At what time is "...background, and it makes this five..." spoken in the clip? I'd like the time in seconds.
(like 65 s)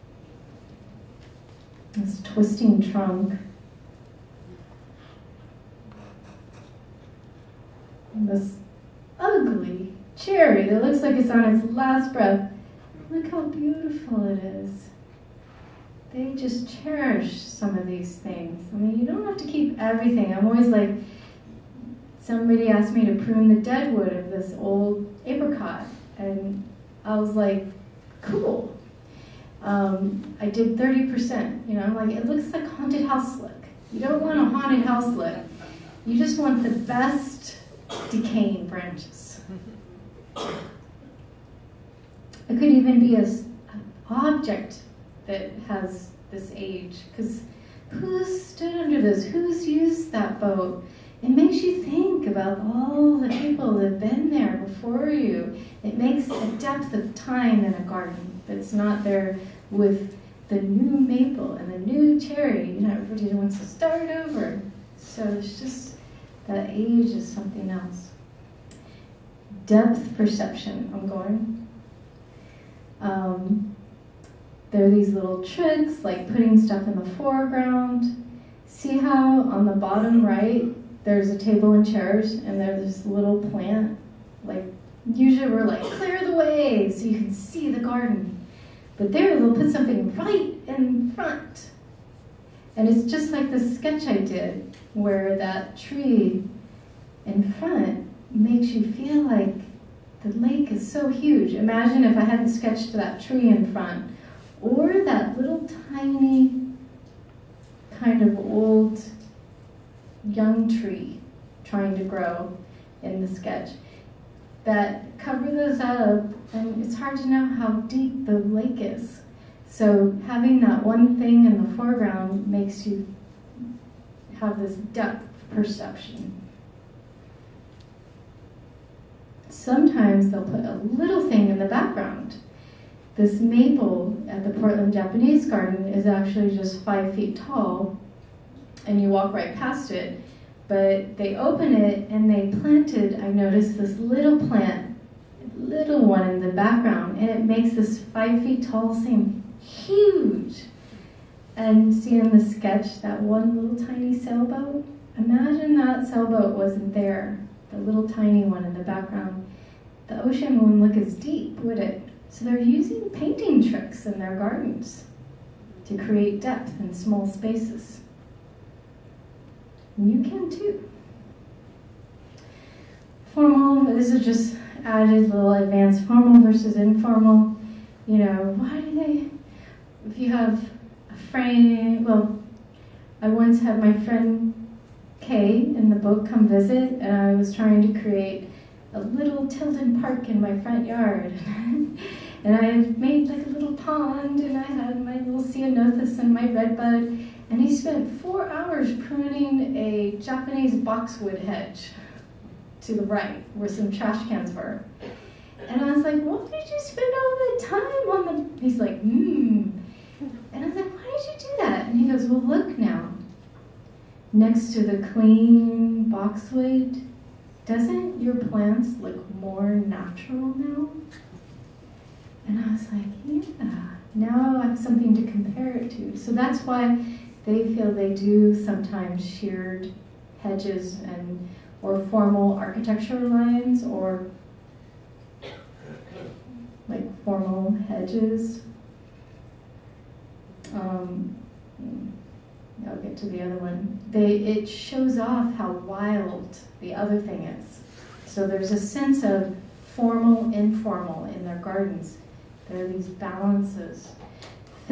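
146 s.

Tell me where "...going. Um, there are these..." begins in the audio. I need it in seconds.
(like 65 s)
71 s.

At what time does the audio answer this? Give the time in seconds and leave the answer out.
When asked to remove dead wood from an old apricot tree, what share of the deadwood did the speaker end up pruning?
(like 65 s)
30 s.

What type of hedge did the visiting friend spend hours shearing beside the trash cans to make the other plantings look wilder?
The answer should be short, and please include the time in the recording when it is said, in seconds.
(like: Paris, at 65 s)
Japanese boxwood, at 200 s.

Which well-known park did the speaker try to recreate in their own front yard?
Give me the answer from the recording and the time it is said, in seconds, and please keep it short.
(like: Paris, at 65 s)
Tilden Park, at 189 s.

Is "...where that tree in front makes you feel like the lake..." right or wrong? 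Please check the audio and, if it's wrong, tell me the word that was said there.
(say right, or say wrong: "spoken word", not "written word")
right.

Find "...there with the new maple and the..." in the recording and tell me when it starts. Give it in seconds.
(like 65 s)
59 s.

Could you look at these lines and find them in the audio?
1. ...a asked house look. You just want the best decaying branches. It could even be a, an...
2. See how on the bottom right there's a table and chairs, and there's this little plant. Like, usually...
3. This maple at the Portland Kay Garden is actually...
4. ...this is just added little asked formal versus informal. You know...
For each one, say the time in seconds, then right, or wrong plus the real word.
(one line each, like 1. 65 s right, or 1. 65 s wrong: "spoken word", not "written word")
1. 34 s wrong: "haunted", not "asked"
2. 78 s right
3. 133 s wrong: "Japanese", not "Kay"
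4. 173 s wrong: "advanced", not "asked".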